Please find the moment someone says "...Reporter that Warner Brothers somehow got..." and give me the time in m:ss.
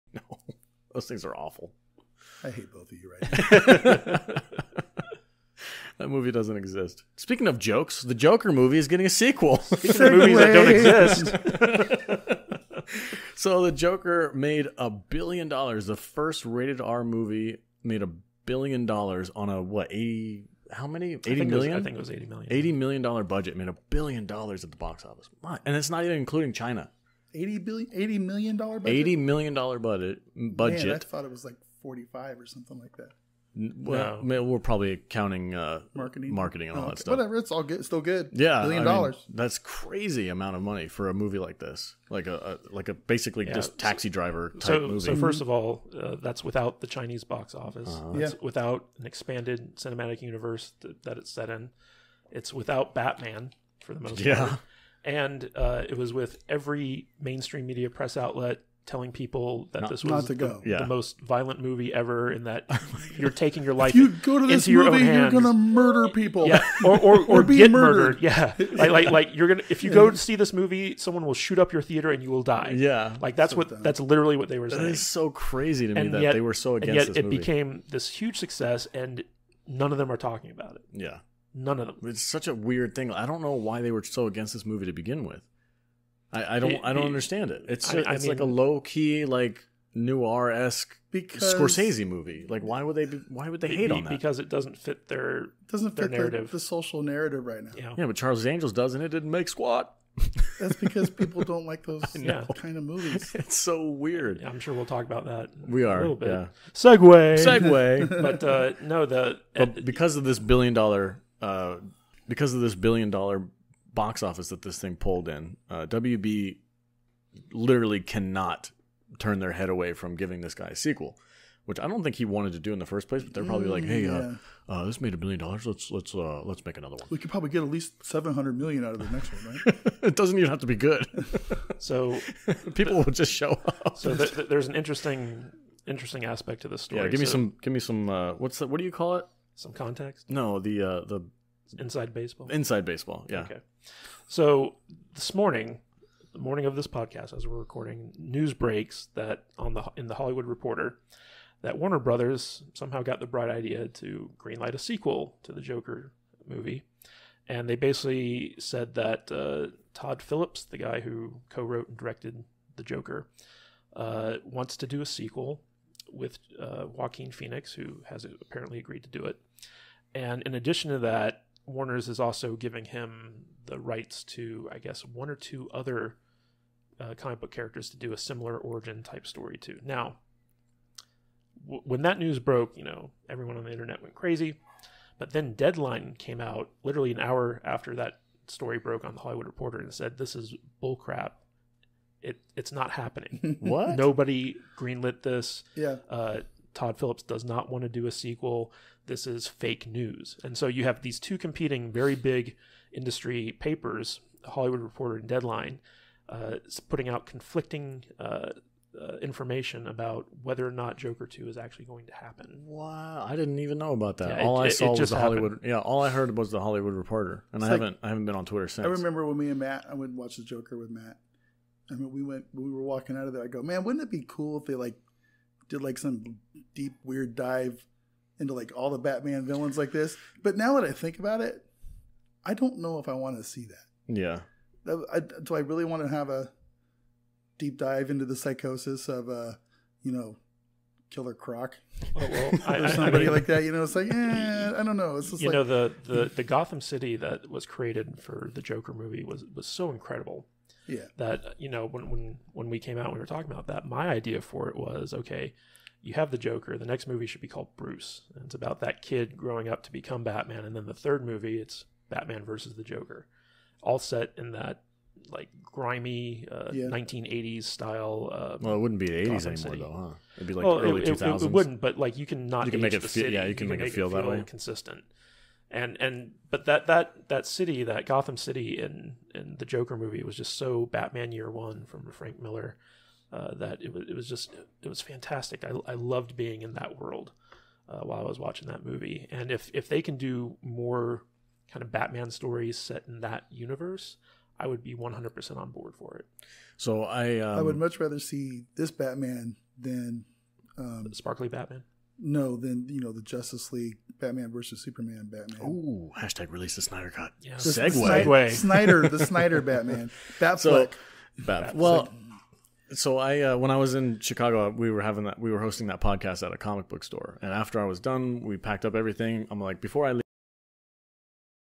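2:30.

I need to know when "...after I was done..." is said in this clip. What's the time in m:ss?
5:17.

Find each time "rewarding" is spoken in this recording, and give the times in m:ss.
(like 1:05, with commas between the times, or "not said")
not said.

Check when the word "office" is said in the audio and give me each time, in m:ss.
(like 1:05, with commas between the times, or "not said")
0:25, 0:47, 1:54.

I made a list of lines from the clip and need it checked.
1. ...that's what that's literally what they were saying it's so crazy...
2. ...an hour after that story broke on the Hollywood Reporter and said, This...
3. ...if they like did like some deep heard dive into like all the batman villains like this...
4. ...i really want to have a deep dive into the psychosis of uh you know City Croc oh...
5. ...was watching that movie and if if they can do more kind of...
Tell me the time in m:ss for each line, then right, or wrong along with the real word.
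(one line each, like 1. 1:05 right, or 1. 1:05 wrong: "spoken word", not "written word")
1. 1:13 right
2. 3:07 right
3. 3:44 wrong: "weird", not "heard"
4. 3:55 wrong: "Killer", not "City"
5. 4:48 right.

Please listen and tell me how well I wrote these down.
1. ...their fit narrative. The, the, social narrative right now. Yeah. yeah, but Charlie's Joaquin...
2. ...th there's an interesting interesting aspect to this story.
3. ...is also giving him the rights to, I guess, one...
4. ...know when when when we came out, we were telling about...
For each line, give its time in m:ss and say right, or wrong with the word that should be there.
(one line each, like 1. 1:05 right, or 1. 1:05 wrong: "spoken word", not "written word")
1. 1:35 wrong: "Angels", not "Joaquin"
2. 2:14 right
3. 2:52 right
4. 4:11 wrong: "talking", not "telling".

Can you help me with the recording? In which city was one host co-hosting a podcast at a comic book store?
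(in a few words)
Chicago.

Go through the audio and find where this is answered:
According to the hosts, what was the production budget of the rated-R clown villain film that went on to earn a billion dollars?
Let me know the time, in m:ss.
0:22.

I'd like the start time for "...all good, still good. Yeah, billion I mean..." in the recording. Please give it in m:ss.
0:37.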